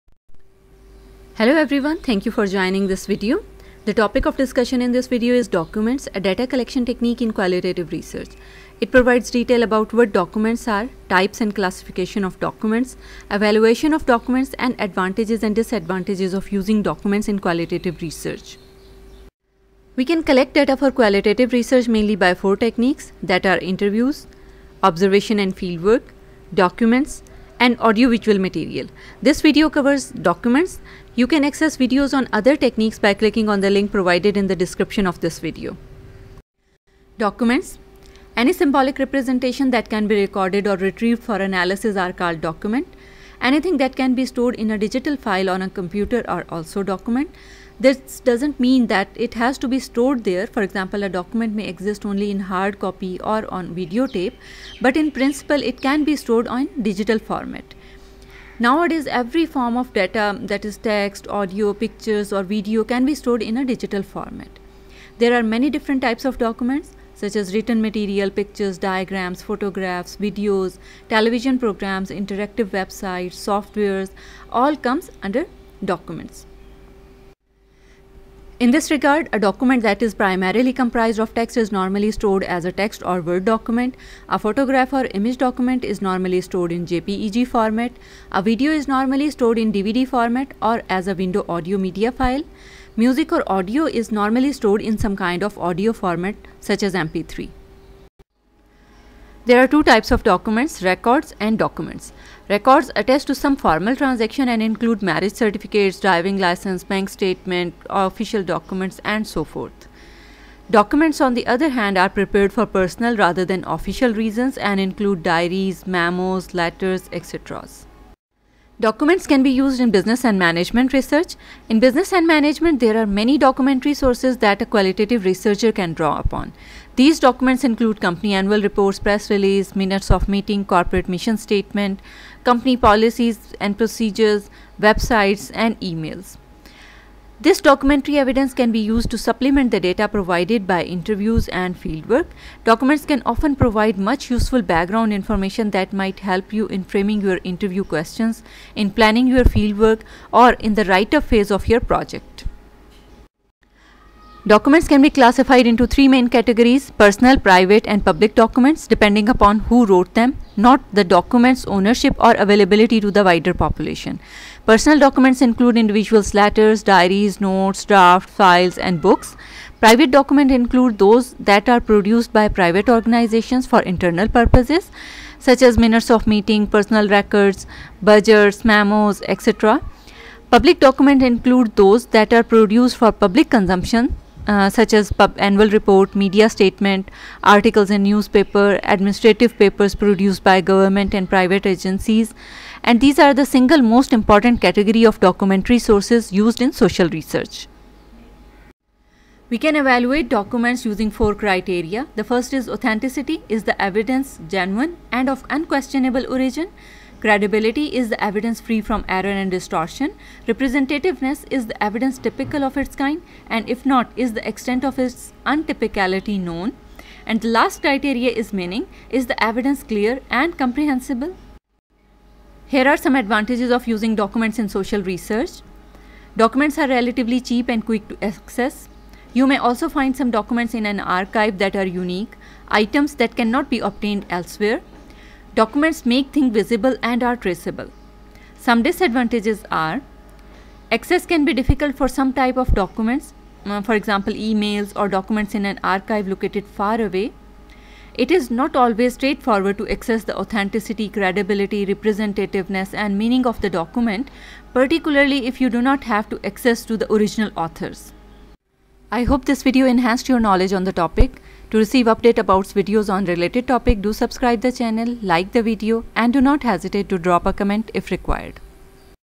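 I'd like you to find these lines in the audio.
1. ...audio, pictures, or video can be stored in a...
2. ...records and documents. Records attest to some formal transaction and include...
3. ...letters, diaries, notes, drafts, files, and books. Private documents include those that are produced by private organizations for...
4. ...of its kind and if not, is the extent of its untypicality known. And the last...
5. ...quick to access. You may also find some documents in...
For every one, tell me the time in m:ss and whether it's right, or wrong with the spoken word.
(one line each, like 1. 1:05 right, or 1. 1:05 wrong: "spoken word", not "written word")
1. 1:01 right
2. 1:40 right
3. 2:46 right
4. 3:32 right
5. 3:47 right.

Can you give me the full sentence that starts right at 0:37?
Documents Any symbolic representation that can be recorded or retrieved for analysis are called document.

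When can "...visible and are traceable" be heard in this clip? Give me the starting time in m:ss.
3:56.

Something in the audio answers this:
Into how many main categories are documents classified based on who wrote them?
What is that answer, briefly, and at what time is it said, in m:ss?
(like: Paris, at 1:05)
3, at 2:35.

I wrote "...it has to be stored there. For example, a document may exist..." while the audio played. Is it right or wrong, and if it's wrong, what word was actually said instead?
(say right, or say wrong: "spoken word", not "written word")
right.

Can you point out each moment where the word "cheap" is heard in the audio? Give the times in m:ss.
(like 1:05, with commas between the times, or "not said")
3:47.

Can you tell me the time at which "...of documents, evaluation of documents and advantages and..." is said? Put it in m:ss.
0:12.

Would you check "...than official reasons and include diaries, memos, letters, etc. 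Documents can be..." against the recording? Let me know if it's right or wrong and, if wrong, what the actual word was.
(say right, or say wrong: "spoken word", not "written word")
right.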